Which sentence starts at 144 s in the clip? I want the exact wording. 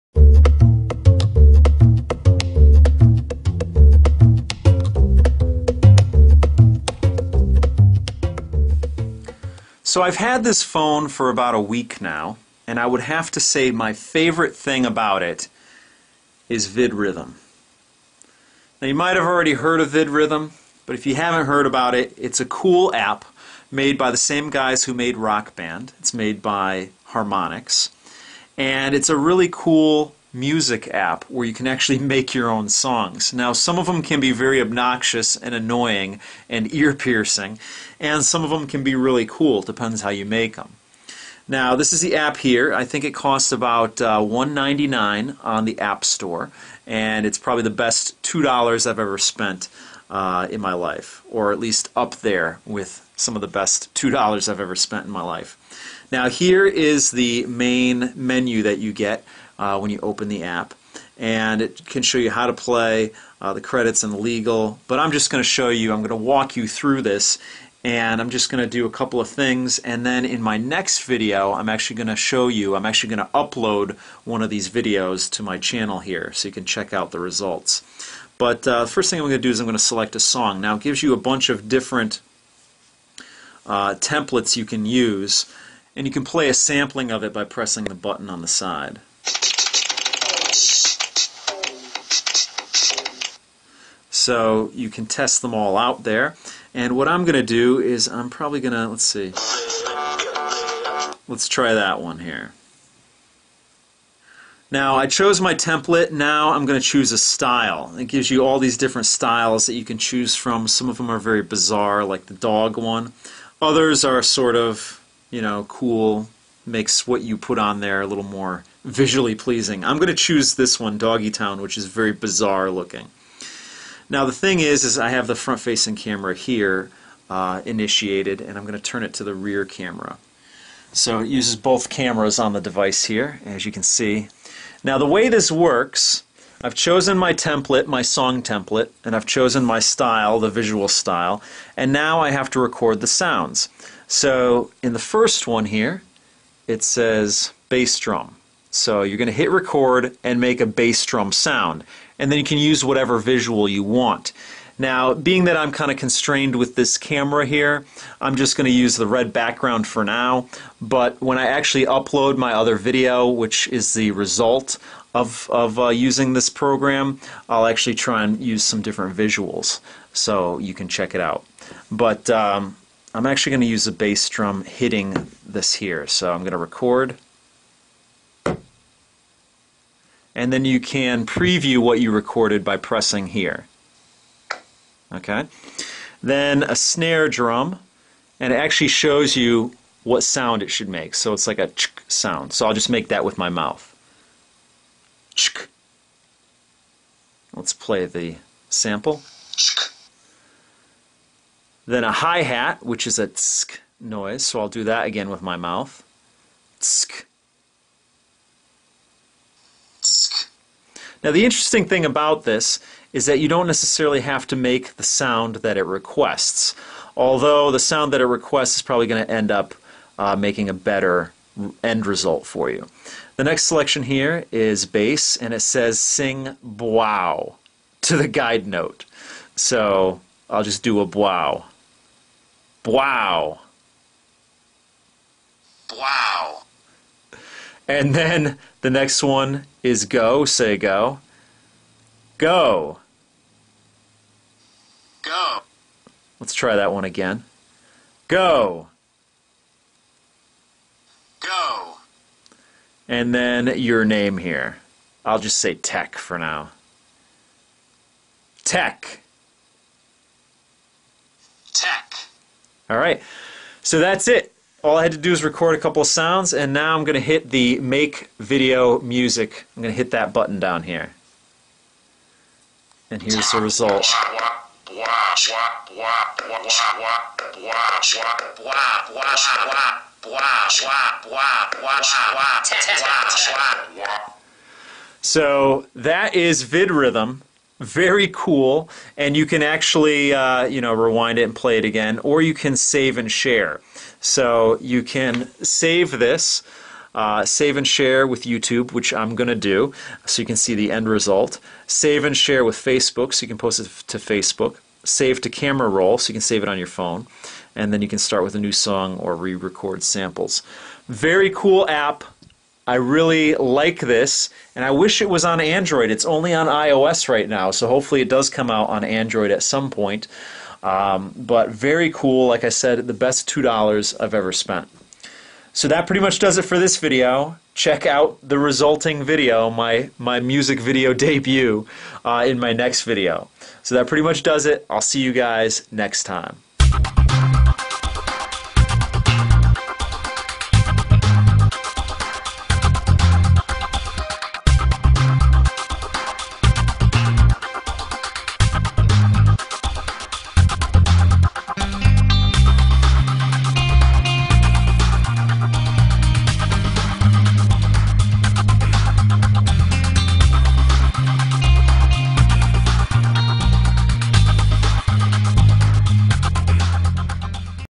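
So in the first one here, it says bass drum.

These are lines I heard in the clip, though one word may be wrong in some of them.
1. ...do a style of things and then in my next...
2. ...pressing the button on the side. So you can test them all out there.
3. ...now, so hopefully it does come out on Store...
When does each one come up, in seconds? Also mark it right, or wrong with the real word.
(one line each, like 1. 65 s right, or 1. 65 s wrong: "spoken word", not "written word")
1. 68 s wrong: "couple", not "style"
2. 87 s right
3. 317 s wrong: "Android", not "Store".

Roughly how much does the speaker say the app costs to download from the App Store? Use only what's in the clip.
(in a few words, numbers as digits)
$1.99.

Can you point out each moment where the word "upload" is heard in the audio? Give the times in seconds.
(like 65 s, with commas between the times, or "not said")
73 s, 161 s.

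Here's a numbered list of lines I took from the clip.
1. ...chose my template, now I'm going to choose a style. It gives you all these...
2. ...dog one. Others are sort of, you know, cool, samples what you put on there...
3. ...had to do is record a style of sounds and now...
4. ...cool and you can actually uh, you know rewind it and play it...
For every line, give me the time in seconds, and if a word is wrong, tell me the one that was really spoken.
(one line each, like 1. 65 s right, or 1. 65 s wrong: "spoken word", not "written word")
1. 105 s right
2. 112 s wrong: "makes", not "samples"
3. 265 s wrong: "couple", not "style"
4. 288 s right.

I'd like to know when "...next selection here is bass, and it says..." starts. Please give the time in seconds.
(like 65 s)
223 s.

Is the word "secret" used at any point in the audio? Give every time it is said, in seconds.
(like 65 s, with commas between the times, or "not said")
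not said.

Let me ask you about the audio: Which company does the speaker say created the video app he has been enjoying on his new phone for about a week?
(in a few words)
Harmonix.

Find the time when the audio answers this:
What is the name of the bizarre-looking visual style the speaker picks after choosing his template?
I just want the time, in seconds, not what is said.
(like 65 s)
120 s.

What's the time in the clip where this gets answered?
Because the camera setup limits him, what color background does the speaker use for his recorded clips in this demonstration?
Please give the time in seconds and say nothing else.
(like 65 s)
159 s.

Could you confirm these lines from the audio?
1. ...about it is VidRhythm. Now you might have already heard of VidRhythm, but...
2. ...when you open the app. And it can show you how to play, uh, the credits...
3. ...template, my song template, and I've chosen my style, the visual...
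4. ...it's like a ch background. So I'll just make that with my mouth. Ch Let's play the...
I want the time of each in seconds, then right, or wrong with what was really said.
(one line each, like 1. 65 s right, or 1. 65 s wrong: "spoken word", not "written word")
1. 14 s right
2. 59 s right
3. 137 s right
4. 191 s wrong: "sound", not "background".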